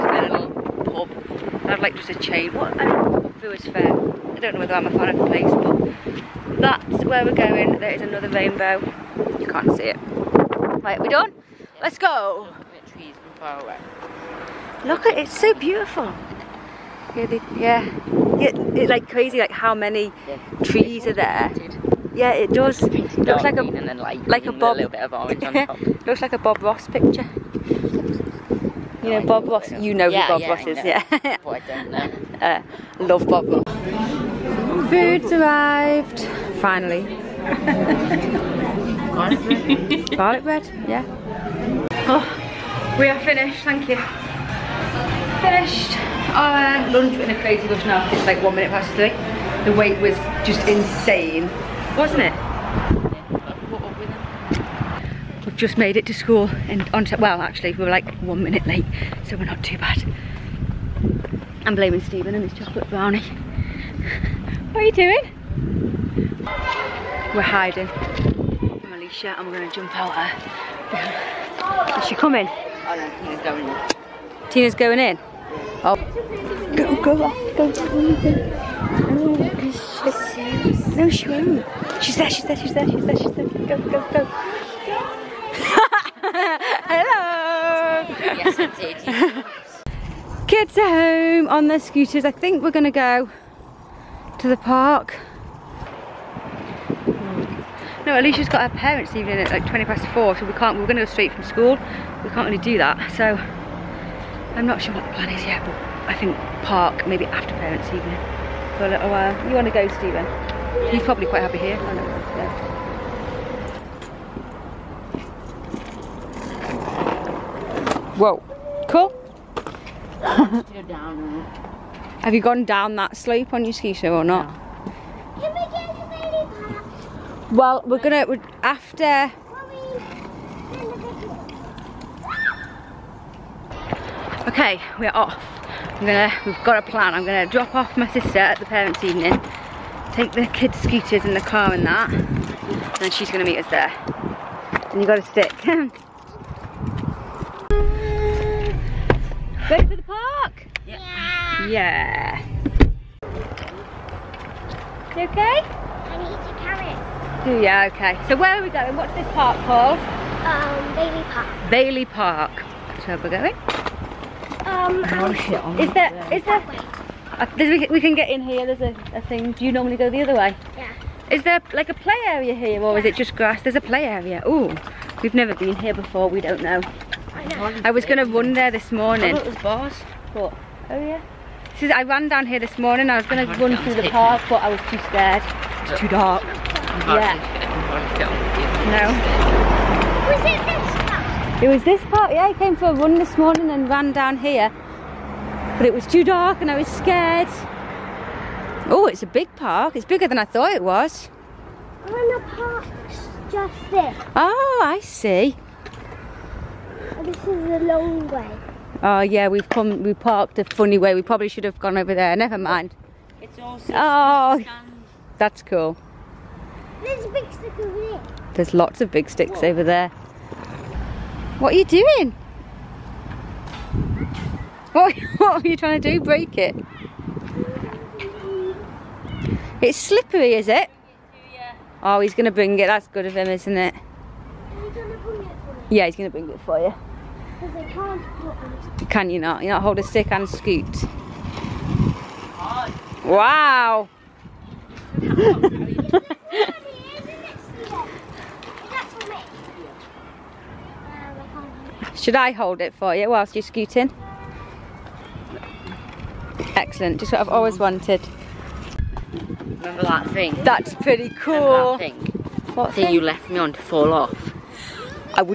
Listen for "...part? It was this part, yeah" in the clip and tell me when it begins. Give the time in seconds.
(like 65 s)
191 s.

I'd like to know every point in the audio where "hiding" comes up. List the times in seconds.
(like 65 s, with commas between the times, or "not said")
67 s.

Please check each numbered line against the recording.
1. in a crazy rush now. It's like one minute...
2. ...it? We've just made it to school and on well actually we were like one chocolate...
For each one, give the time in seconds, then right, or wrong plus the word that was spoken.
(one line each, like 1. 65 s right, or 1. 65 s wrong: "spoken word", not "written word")
1. 47 s right
2. 52 s wrong: "minute", not "chocolate".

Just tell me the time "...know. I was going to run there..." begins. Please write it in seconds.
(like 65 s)
177 s.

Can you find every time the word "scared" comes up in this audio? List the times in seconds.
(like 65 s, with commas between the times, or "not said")
185 s, 196 s.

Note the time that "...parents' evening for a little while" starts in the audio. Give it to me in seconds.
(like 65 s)
107 s.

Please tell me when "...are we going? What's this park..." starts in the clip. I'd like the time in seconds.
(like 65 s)
158 s.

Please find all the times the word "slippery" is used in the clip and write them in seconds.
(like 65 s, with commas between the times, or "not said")
229 s.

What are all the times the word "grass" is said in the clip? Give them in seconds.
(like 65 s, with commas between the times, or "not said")
173 s.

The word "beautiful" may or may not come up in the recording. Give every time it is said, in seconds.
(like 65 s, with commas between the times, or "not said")
15 s.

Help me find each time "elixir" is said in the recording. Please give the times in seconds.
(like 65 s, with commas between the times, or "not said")
not said.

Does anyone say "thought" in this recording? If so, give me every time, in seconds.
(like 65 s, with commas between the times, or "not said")
200 s.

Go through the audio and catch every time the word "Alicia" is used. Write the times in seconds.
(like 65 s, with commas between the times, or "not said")
68 s, 98 s.